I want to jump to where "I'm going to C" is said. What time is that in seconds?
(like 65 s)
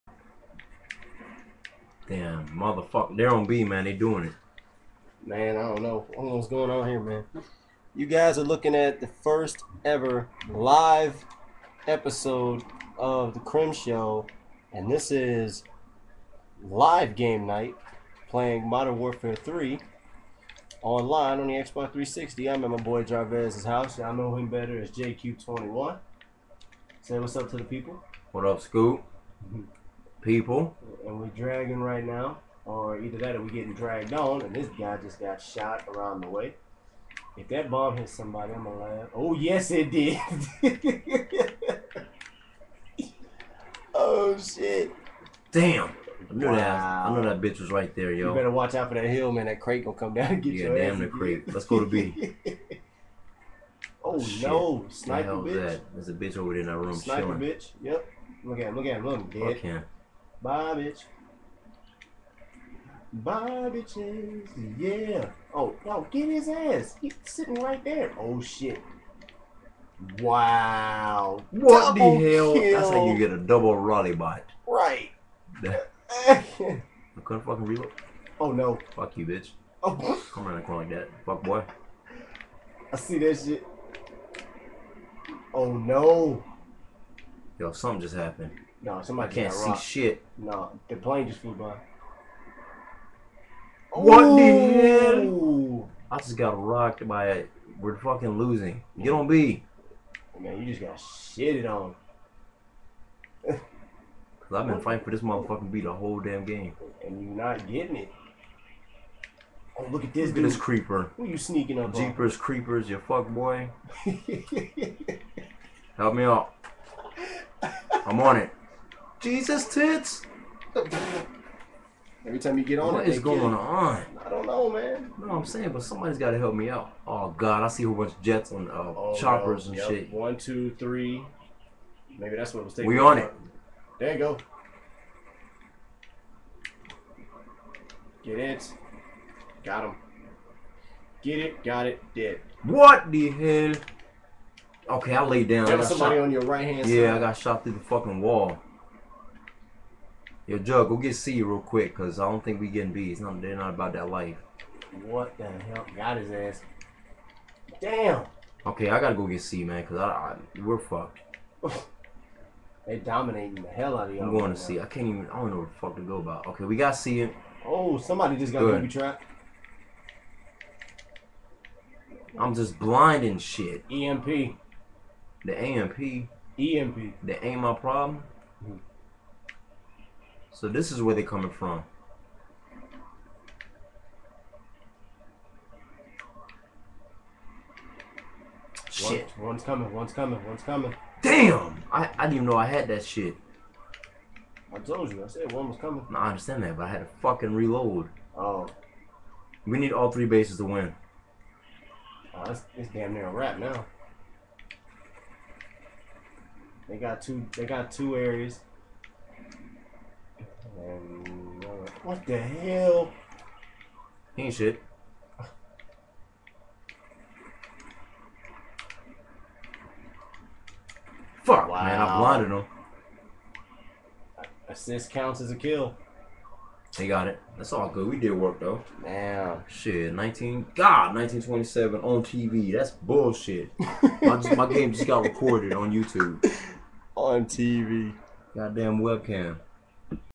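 164 s.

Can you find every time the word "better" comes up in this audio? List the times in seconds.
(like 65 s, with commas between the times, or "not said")
24 s, 48 s.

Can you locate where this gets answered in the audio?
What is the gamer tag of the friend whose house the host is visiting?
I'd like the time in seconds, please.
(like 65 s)
24 s.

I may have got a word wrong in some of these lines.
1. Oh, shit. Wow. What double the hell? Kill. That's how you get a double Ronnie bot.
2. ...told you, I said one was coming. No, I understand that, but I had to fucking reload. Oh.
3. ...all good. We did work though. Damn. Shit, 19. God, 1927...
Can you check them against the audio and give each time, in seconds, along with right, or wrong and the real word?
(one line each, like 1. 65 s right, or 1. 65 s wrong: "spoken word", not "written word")
1. 68 s right
2. 194 s right
3. 227 s right.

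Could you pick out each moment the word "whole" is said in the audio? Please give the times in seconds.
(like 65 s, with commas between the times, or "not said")
105 s, 127 s.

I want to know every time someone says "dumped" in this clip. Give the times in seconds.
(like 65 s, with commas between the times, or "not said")
not said.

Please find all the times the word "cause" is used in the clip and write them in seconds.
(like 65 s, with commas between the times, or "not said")
103 s, 151 s, 159 s.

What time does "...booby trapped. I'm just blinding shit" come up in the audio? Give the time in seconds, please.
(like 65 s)
168 s.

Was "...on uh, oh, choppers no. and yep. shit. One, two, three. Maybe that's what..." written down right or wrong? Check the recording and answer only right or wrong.
right.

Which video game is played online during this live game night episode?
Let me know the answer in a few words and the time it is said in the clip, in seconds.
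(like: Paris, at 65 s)
Modern Warfare 3, at 18 s.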